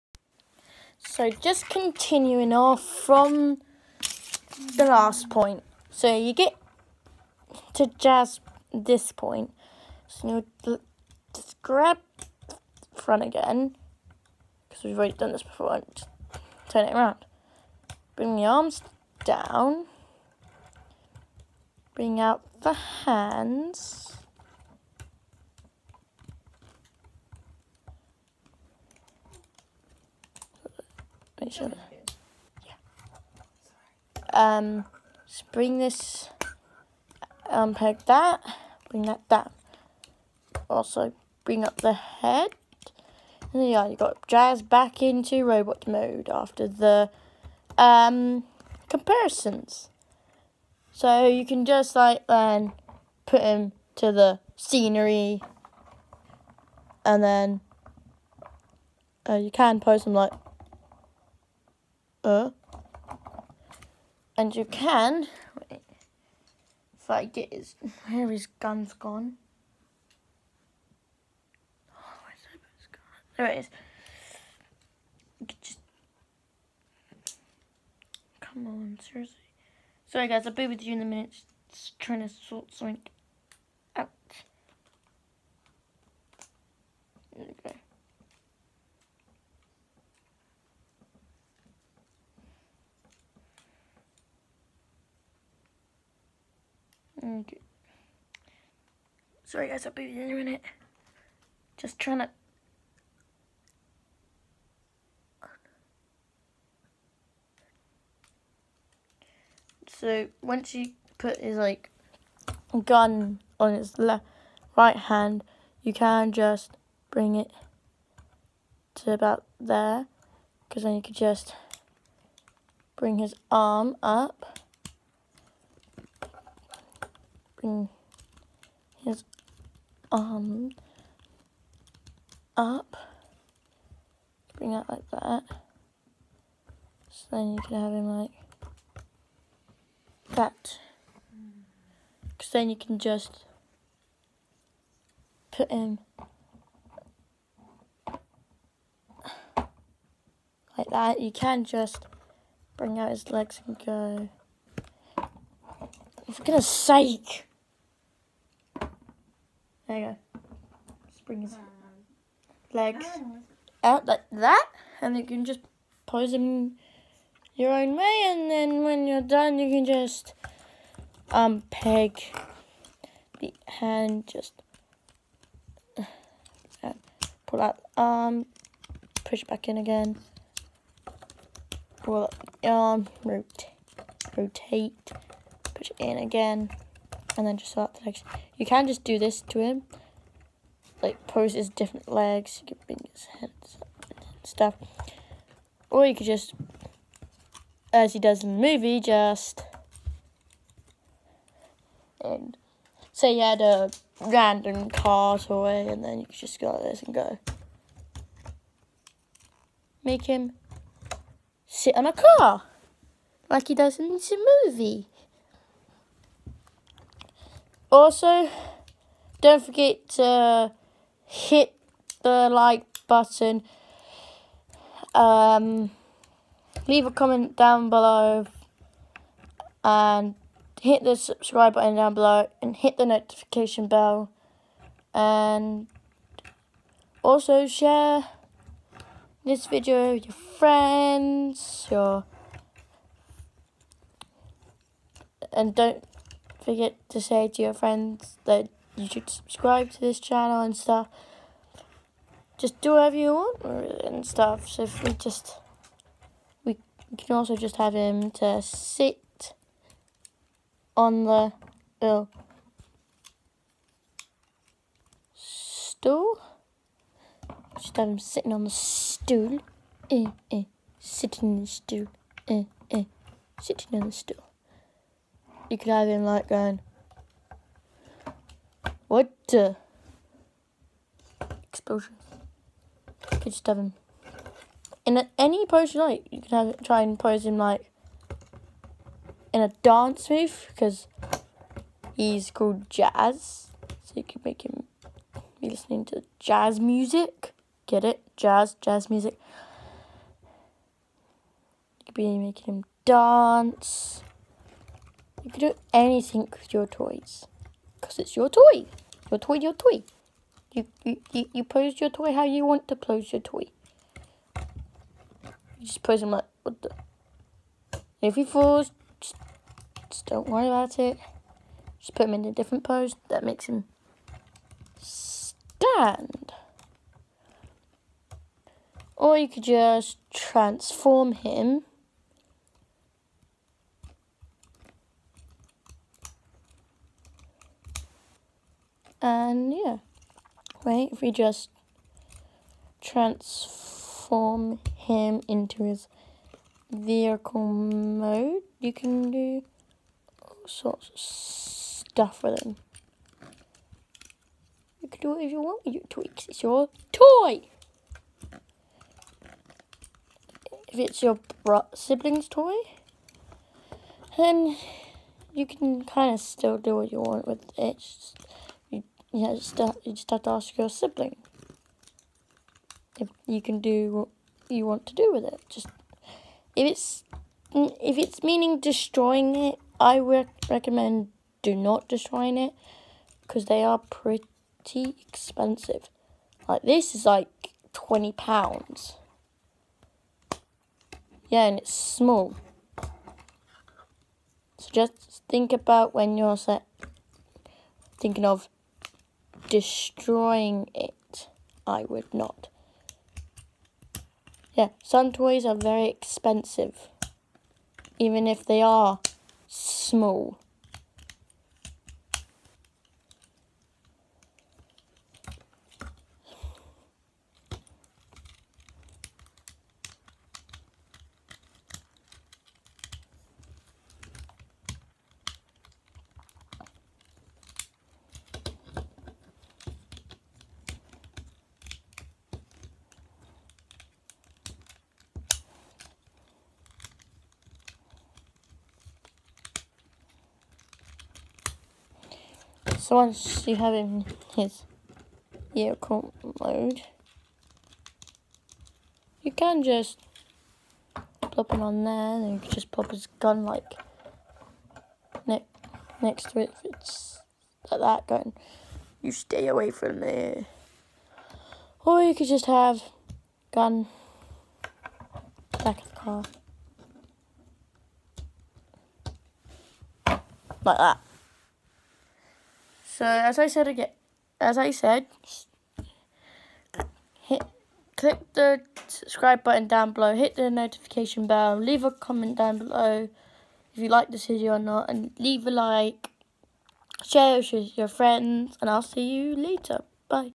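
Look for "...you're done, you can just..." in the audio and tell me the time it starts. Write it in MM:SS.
02:49.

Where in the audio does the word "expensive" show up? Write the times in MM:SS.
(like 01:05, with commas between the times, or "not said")
06:25, 06:46.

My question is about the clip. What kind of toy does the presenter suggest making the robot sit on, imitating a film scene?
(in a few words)
car toy.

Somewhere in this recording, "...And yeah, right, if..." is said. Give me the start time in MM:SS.
05:39.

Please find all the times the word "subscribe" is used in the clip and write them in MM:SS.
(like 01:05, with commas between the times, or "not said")
03:51, 04:09, 07:59.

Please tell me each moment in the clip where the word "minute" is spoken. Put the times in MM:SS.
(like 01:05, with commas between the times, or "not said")
01:21, 01:40.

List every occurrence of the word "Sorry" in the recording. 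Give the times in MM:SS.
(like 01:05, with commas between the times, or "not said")
01:20, 01:39.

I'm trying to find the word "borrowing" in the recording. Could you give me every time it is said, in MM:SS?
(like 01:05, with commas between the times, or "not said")
not said.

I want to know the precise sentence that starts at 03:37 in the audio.
Also, don't forget to hit the like button.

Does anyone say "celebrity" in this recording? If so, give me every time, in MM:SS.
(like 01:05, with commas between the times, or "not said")
not said.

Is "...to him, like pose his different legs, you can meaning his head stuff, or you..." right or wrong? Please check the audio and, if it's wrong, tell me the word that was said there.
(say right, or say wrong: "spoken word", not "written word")
wrong: "bring", not "meaning".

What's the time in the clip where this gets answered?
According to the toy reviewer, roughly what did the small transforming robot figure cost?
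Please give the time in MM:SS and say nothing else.
06:27.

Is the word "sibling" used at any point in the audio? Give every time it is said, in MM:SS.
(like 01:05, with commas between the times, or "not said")
06:01, 06:10.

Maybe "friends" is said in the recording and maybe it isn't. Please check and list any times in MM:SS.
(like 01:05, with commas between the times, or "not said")
04:00, 04:07, 08:08.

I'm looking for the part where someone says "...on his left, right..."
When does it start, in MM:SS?
01:53.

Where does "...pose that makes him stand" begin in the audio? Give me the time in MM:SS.
05:22.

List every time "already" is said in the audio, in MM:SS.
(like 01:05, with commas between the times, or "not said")
00:14.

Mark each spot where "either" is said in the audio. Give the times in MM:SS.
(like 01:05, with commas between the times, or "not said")
not said.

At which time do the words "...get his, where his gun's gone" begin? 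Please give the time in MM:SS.
01:07.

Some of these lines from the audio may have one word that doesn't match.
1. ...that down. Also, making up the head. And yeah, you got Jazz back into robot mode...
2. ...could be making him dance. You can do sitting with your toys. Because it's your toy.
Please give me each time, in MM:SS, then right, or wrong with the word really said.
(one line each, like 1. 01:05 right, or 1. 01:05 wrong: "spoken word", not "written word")
1. 00:39 wrong: "bring", not "making"
2. 05:02 wrong: "anything", not "sitting".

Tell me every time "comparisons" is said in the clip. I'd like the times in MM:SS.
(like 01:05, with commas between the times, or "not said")
00:48.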